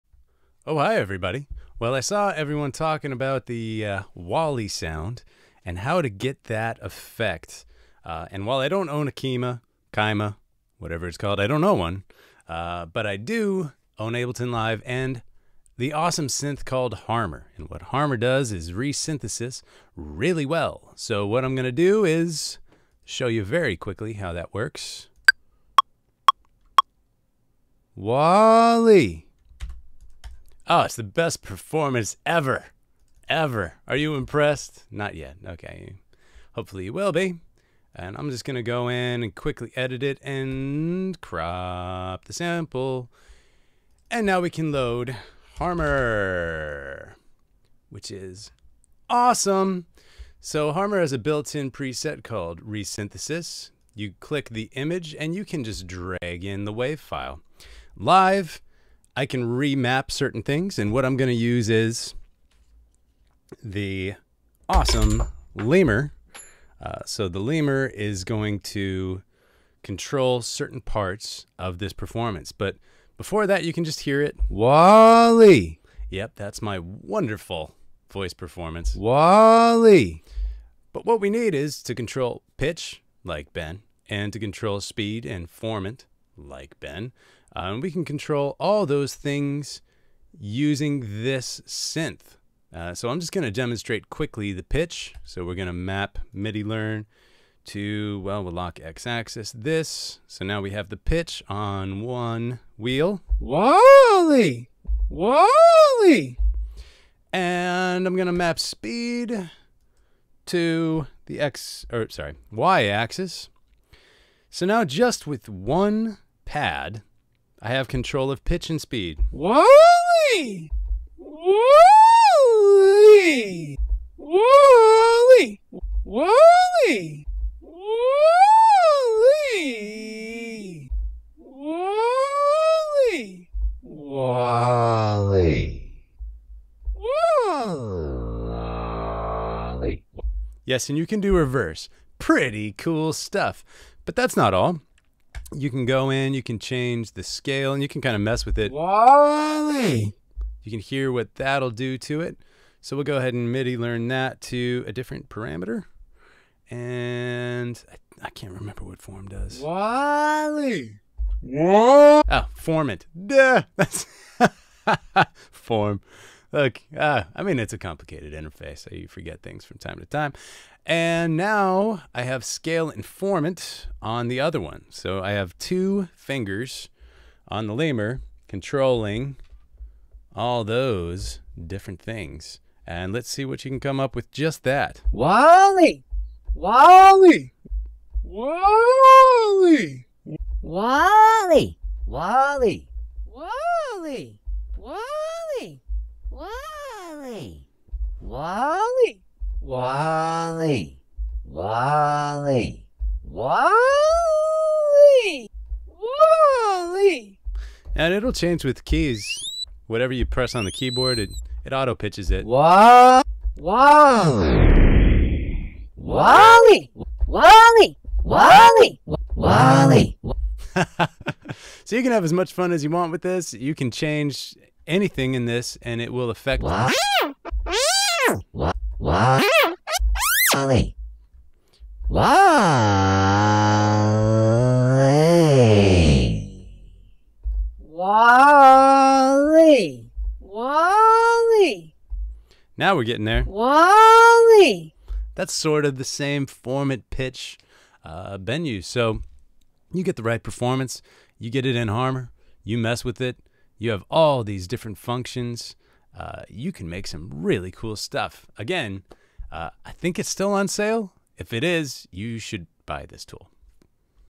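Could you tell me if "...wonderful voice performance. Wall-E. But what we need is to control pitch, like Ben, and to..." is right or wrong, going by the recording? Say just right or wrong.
right.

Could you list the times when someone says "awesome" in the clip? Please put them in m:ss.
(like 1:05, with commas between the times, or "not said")
0:15, 0:49, 1:04.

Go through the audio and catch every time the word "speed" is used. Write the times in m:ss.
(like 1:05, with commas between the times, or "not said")
1:24, 1:48, 1:58.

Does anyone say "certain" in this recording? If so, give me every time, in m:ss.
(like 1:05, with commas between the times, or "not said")
1:00, 1:10.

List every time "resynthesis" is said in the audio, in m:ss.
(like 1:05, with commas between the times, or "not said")
0:18, 0:52.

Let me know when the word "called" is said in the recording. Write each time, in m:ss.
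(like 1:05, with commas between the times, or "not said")
0:11, 0:16, 0:52.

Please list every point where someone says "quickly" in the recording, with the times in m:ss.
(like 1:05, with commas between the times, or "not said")
0:23, 0:39, 1:34.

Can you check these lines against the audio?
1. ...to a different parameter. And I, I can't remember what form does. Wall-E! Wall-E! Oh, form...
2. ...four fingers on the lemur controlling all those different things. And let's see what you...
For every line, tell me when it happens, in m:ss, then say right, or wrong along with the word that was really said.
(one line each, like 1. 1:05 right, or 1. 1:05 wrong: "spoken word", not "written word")
1. 2:34 right
2. 2:55 wrong: "two", not "four".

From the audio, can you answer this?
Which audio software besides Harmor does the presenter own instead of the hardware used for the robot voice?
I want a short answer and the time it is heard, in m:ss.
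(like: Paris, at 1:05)
Ableton Live, at 0:14.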